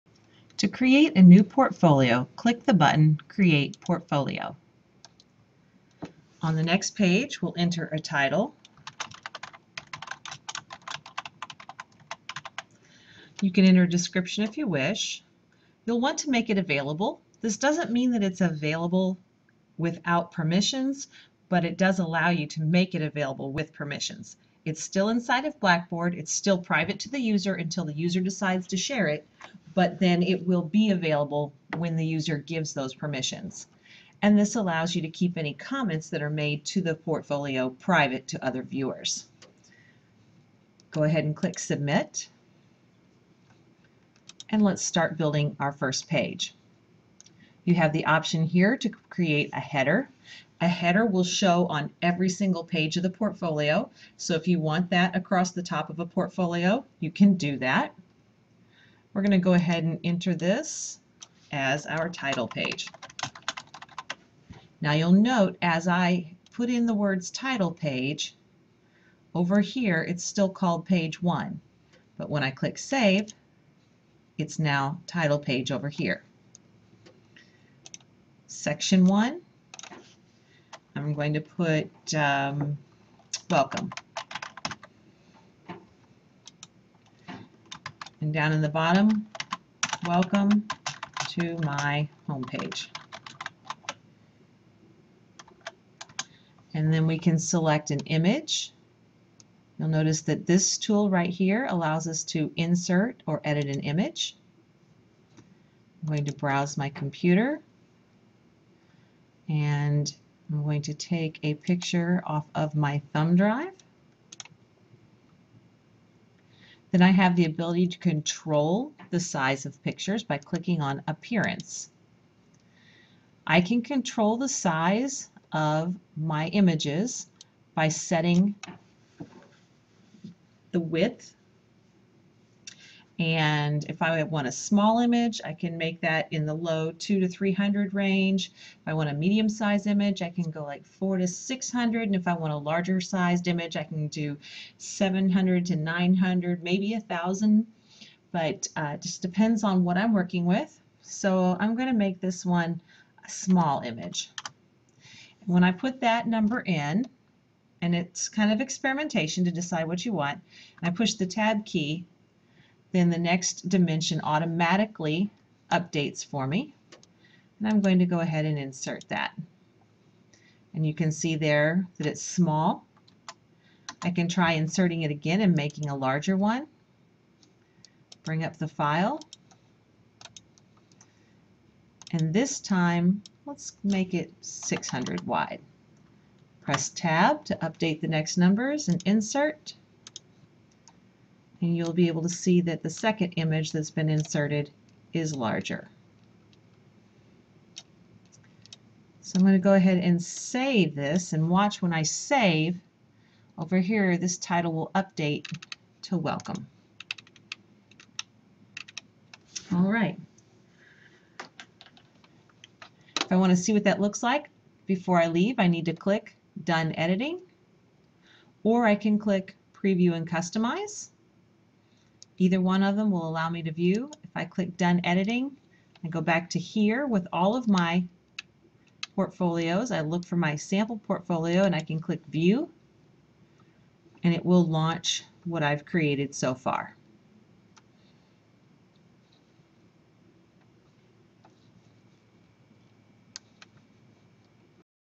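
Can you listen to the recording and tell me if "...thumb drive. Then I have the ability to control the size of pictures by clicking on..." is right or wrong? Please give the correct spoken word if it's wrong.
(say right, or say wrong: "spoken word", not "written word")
right.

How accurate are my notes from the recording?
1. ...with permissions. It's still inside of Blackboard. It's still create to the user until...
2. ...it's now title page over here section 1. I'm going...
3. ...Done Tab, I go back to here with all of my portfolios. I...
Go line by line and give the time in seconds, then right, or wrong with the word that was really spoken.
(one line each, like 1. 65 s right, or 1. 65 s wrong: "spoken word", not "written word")
1. 23 s wrong: "private", not "create"
2. 74 s right
3. 224 s wrong: "Editing", not "Tab".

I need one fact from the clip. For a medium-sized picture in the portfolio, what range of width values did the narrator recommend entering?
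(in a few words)
400 to 600.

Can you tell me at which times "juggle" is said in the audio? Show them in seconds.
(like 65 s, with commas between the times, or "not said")
not said.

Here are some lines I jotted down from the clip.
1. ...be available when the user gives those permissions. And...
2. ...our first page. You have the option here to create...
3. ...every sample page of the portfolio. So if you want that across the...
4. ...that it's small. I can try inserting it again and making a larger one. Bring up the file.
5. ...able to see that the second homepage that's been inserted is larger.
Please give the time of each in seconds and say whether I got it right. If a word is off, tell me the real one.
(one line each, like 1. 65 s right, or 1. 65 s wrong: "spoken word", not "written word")
1. 30 s right
2. 45 s right
3. 52 s wrong: "single", not "sample"
4. 171 s right
5. 192 s wrong: "image", not "homepage".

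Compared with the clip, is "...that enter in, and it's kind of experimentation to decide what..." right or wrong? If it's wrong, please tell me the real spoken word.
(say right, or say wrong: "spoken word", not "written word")
wrong: "number", not "enter".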